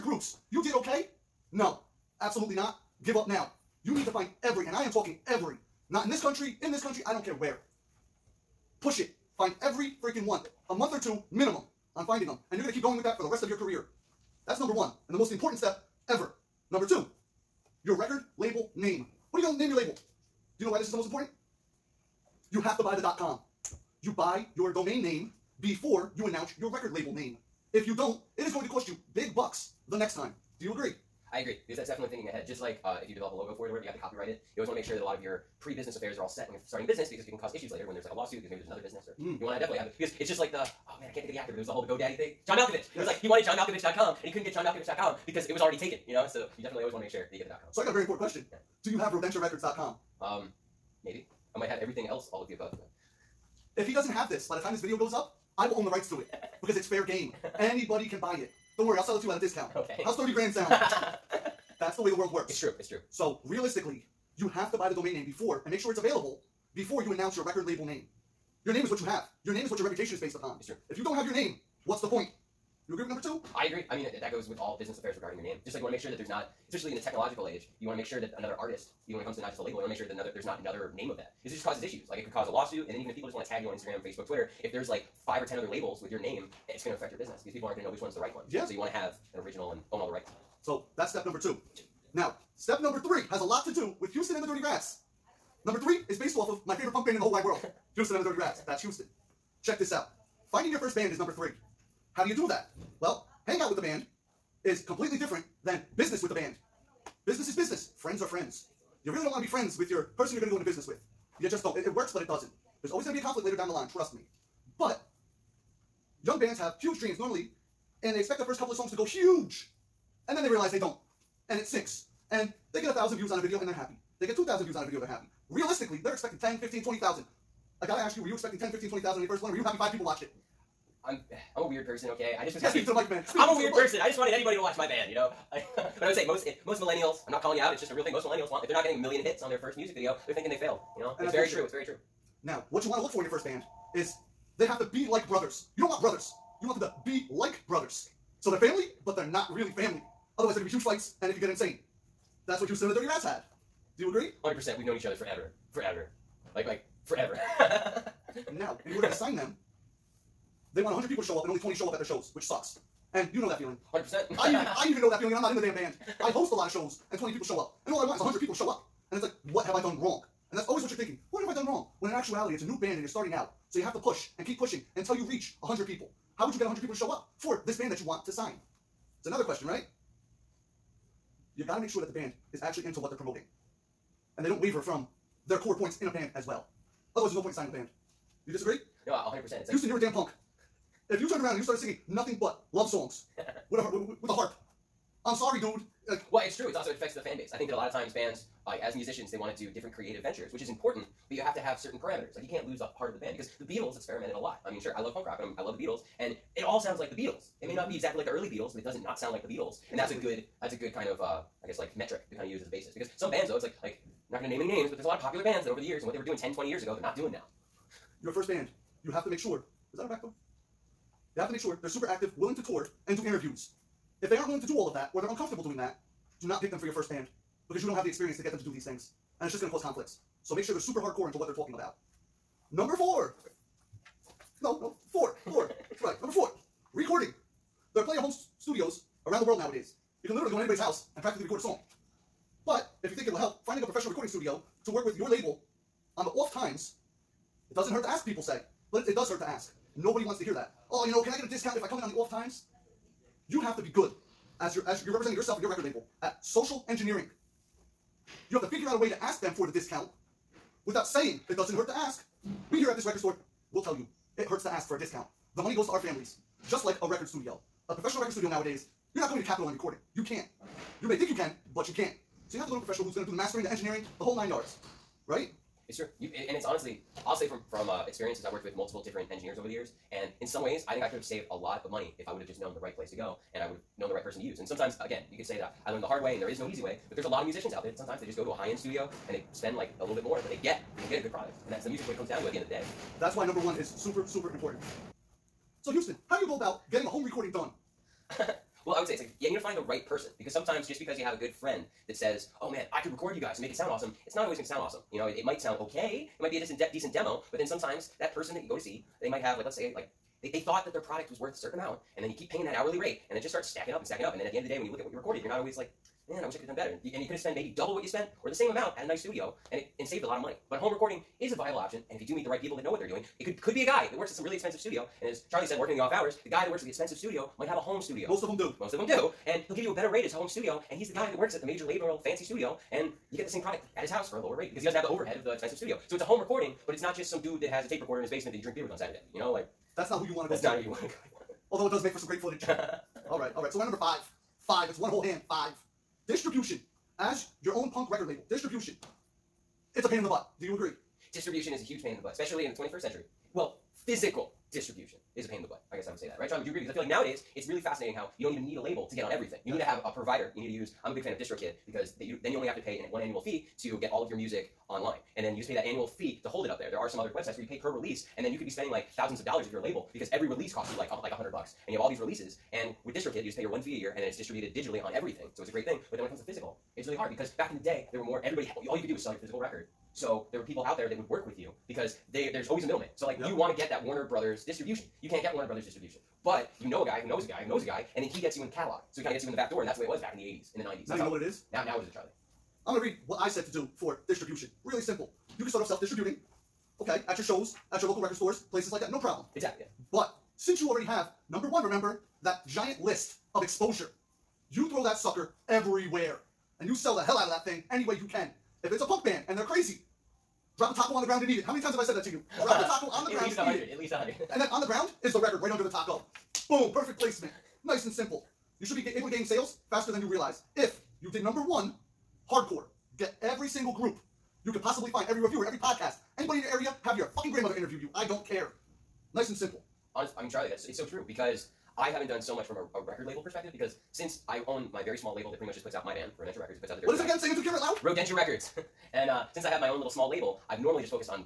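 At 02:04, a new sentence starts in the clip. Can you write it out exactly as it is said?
They get 2,000 views on a video, they're happy.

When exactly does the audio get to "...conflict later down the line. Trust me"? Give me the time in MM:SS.
01:53.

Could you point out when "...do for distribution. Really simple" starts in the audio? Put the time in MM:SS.
06:33.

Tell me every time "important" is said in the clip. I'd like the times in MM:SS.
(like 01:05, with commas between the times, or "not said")
00:15, 00:21, 00:48, 03:20, 04:54.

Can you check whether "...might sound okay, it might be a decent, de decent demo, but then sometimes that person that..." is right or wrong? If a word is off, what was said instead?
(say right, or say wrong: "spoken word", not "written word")
right.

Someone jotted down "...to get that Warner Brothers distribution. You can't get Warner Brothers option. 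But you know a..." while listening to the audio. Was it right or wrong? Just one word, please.
wrong.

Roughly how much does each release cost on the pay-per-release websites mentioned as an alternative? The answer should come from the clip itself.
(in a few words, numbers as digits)
$100.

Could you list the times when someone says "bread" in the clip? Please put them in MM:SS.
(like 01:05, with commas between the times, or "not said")
not said.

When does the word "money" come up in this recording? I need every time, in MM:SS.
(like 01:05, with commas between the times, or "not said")
04:25, 04:41, 05:20.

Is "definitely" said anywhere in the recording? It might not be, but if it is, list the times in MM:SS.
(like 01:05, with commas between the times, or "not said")
00:31, 00:39, 00:46.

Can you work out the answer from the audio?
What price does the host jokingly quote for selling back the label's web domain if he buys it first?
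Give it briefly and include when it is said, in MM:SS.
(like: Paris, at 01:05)
30 grand, at 01:00.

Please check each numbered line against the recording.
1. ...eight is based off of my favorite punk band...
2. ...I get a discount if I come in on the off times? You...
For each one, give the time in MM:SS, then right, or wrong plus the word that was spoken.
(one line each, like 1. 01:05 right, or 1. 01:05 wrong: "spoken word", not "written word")
1. 01:35 wrong: "three", not "eight"
2. 04:11 right.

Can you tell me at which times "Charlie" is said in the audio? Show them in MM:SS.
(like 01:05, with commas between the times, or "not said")
05:25, 05:56, 06:32, 07:10.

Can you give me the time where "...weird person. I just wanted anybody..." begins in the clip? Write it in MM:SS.
02:13.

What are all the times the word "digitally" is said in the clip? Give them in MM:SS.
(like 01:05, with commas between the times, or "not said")
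06:14.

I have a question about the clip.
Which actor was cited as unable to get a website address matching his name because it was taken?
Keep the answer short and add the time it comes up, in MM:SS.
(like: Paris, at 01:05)
John Malkovich, at 00:42.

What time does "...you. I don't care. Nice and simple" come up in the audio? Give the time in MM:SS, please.
07:08.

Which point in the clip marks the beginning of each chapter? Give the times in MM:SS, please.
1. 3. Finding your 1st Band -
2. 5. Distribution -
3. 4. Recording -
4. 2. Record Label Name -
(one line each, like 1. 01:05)
1. 01:31
2. 05:43
3. 03:52
4. 00:16.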